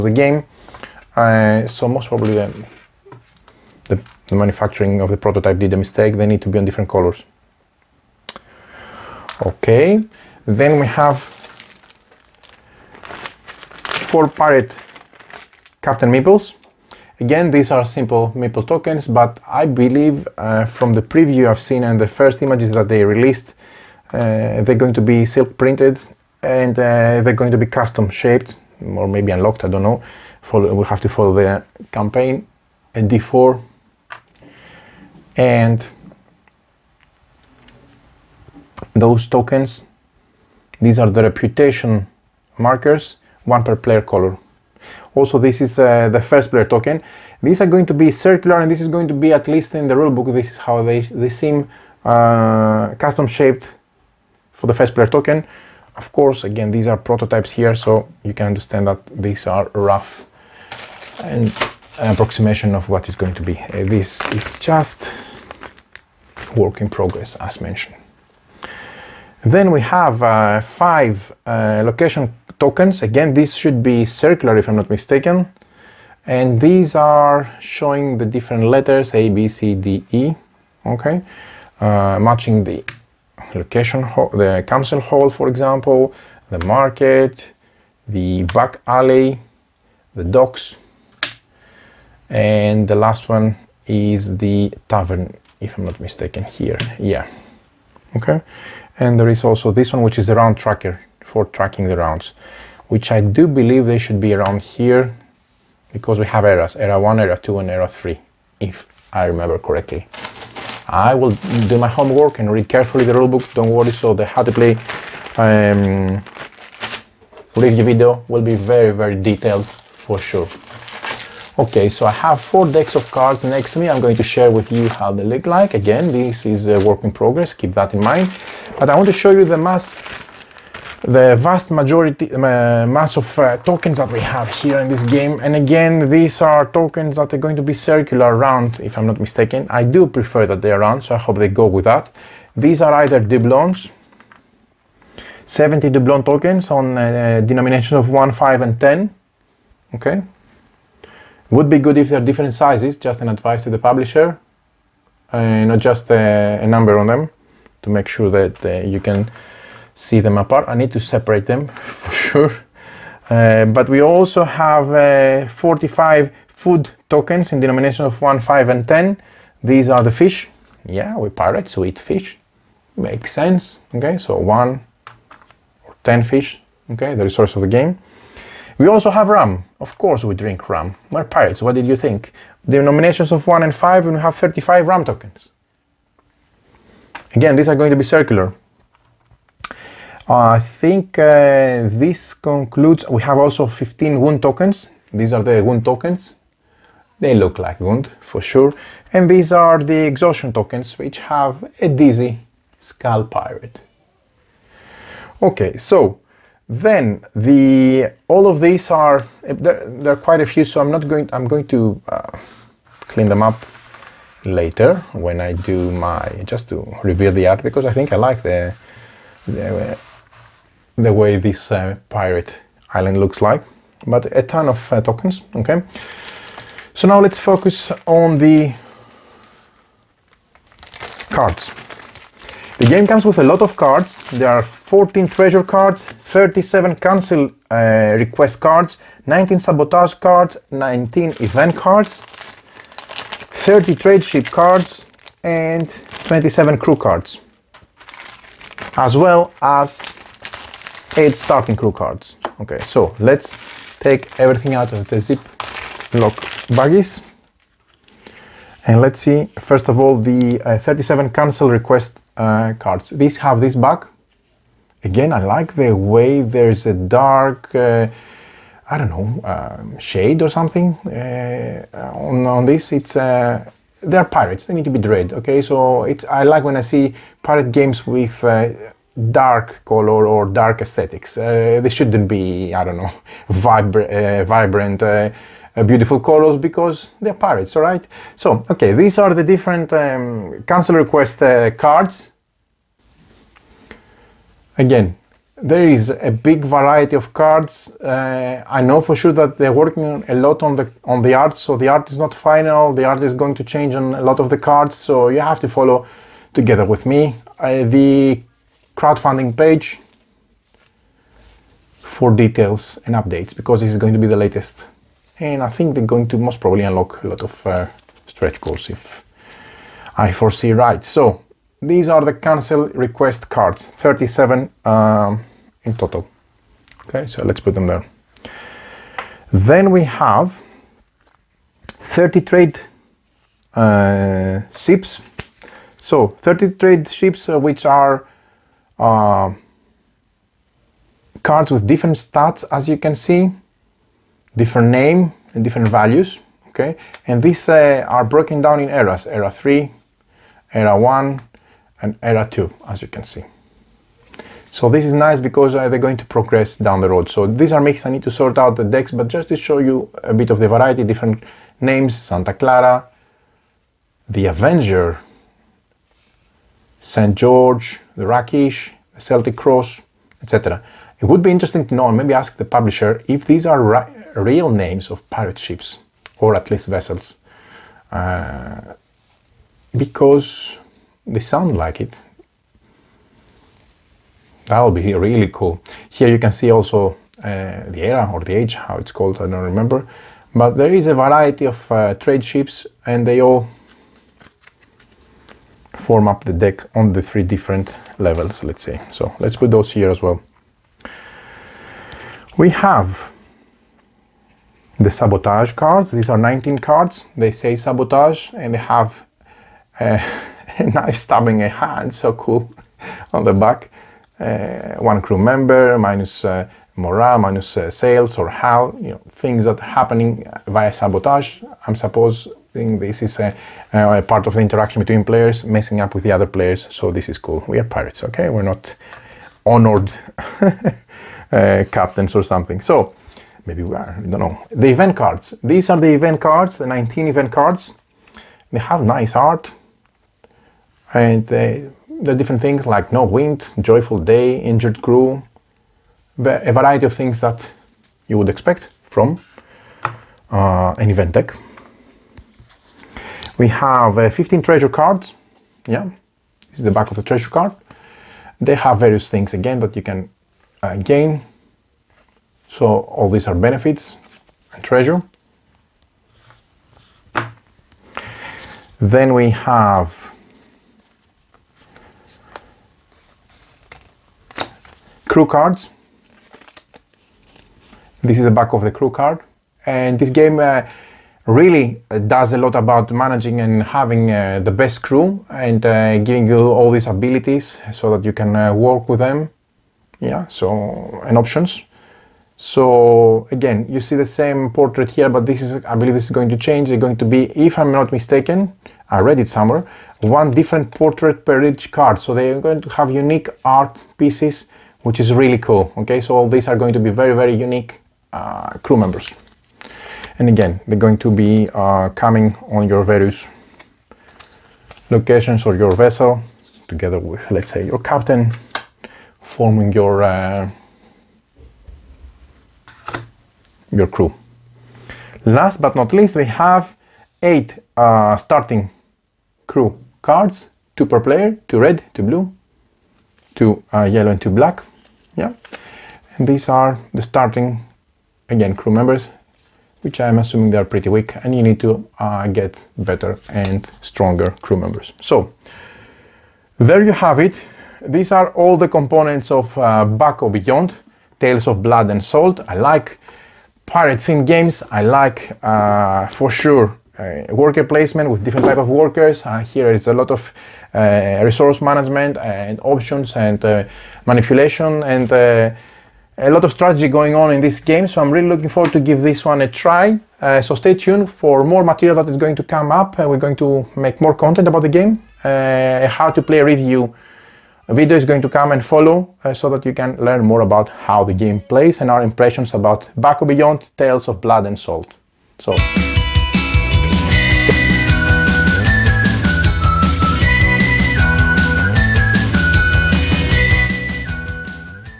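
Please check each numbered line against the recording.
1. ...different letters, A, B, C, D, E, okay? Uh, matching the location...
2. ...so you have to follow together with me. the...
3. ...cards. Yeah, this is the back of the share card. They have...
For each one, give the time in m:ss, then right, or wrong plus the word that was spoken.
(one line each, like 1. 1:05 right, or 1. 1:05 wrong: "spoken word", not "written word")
1. 1:18 right
2. 5:04 right
3. 7:34 wrong: "treasure", not "share".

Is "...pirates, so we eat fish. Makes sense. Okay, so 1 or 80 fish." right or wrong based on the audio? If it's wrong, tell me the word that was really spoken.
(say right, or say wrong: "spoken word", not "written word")
wrong: "10", not "80".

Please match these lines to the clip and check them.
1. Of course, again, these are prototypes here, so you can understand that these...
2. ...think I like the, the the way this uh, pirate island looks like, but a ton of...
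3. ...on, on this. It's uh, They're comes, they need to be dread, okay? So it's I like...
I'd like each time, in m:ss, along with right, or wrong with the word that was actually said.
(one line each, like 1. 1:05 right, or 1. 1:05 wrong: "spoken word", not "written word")
1. 0:55 right
2. 3:37 right
3. 4:32 wrong: "pirates", not "comes".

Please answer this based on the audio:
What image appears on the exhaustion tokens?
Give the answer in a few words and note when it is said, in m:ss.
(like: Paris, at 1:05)
A dizzy skull pirate, at 3:21.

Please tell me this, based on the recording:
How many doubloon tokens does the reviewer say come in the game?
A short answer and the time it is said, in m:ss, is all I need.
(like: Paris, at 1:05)
70, at 2:25.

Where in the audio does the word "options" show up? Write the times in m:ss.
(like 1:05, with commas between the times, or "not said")
8:11, 9:22.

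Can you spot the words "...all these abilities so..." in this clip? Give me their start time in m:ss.
8:06.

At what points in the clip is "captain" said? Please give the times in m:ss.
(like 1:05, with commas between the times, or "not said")
0:15, 7:11, 8:37.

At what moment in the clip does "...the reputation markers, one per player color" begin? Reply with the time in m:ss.
0:41.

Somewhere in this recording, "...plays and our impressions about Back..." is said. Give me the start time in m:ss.
9:41.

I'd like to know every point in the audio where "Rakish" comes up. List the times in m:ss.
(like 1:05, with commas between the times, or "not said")
6:08.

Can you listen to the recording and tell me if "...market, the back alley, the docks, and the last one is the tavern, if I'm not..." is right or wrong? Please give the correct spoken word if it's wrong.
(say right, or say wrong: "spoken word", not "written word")
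right.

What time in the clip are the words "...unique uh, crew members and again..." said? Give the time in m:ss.
8:27.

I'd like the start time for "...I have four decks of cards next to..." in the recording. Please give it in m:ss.
2:02.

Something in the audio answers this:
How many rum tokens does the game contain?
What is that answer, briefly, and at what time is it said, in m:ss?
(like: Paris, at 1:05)
35, at 3:04.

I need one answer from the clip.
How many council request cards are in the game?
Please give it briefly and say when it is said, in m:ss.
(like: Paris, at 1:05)
37, at 3:56.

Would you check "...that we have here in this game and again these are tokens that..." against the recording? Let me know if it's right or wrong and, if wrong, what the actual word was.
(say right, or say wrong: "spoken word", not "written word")
right.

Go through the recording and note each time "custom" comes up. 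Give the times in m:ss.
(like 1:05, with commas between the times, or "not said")
0:27, 0:52.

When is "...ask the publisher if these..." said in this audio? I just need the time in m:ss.
6:12.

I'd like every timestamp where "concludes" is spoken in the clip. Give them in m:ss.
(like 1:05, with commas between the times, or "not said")
3:12.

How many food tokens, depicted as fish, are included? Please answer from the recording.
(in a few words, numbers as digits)
45.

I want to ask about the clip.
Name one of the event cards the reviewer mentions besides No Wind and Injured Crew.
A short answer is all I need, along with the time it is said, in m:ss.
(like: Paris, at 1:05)
Joyful Day, at 7:23.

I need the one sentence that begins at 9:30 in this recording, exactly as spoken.
Uh, so stay tuned for more material that is going to come up.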